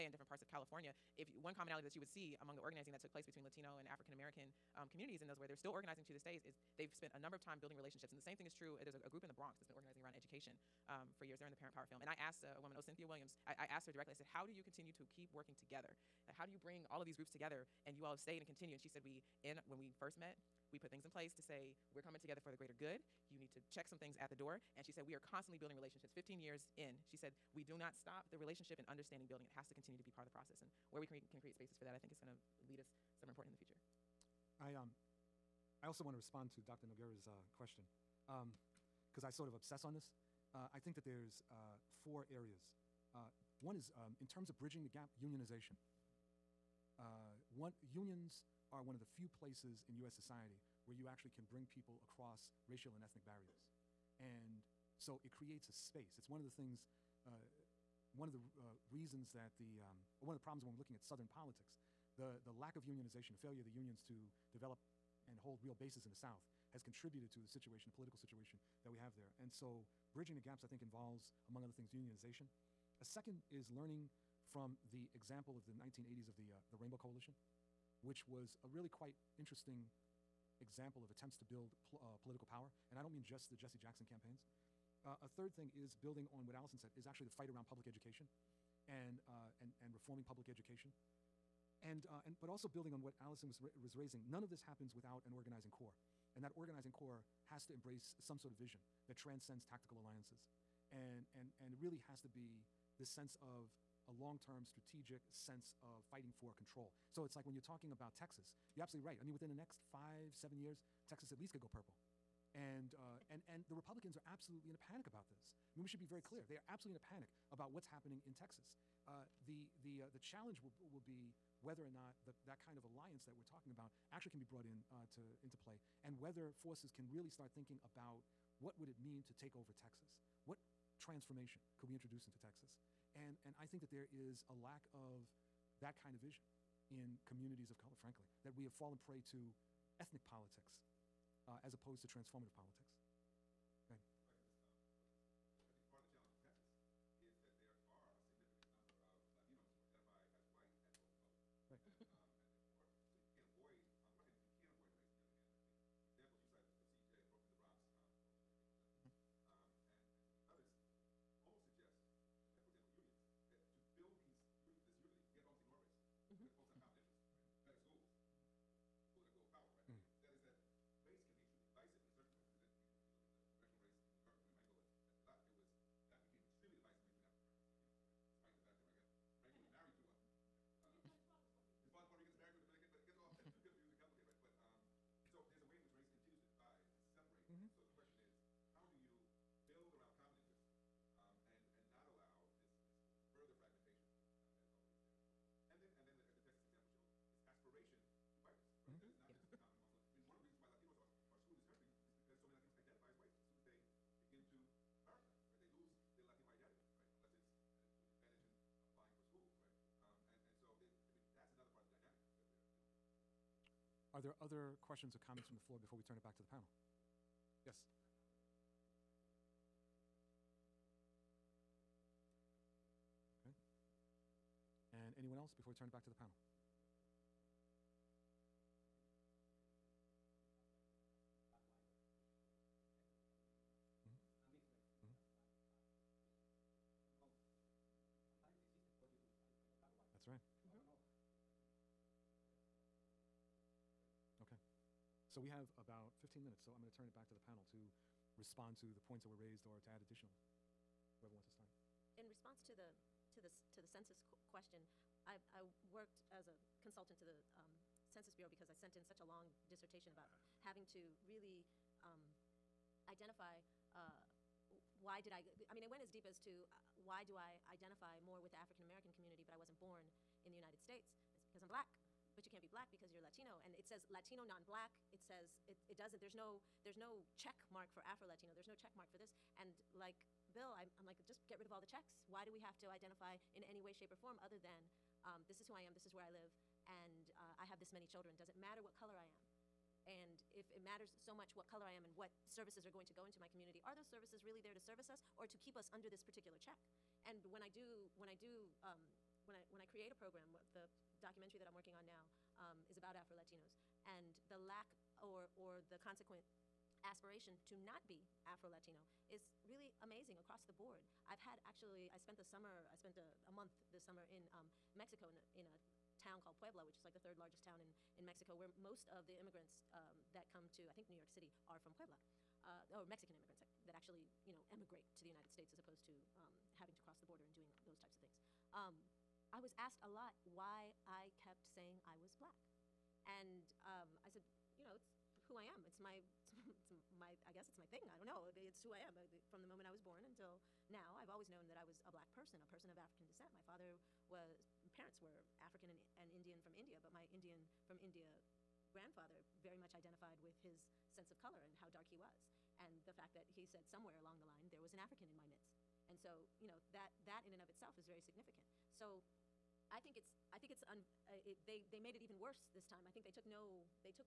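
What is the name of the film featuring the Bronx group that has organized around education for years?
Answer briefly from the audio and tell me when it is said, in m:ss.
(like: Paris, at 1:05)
Parent Power, at 0:11.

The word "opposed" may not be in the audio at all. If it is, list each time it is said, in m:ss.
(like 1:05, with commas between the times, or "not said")
2:21, 5:25.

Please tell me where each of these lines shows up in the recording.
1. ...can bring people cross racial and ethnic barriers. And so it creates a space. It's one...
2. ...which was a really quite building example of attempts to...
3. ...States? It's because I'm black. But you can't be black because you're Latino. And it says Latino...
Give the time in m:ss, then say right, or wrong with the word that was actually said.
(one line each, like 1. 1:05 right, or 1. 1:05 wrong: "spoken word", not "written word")
1. 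0:51 wrong: "across", not "cross"
2. 1:18 wrong: "interesting", not "building"
3. 4:30 right.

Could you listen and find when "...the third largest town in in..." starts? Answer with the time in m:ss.
5:17.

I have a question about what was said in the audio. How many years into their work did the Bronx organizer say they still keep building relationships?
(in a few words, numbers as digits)
15.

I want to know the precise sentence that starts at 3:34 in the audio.
Are there other questions or comments from the floor before we turn it back to the panel?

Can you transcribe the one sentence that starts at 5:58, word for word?
So I think it's, I think it's, un, uh, it, they, they made it even worse this time.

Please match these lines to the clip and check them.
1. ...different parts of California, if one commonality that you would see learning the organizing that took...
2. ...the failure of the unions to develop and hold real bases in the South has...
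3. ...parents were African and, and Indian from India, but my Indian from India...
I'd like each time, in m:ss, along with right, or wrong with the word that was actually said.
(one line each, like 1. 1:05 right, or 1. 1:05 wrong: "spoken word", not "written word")
1. 0:00 wrong: "among", not "learning"
2. 1:03 right
3. 5:44 right.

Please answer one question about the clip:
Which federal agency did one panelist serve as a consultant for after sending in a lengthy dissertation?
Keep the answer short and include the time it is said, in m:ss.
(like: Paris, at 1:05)
Census Bureau, at 4:18.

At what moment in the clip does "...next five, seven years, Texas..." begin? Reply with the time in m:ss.
1:49.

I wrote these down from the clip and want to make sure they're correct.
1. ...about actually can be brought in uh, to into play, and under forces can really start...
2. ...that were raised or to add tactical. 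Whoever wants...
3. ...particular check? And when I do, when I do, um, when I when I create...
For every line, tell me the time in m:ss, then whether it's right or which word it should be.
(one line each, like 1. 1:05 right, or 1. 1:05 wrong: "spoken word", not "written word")
1. 2:03 wrong: "whether", not "under"
2. 4:09 wrong: "additional", not "tactical"
3. 4:56 right.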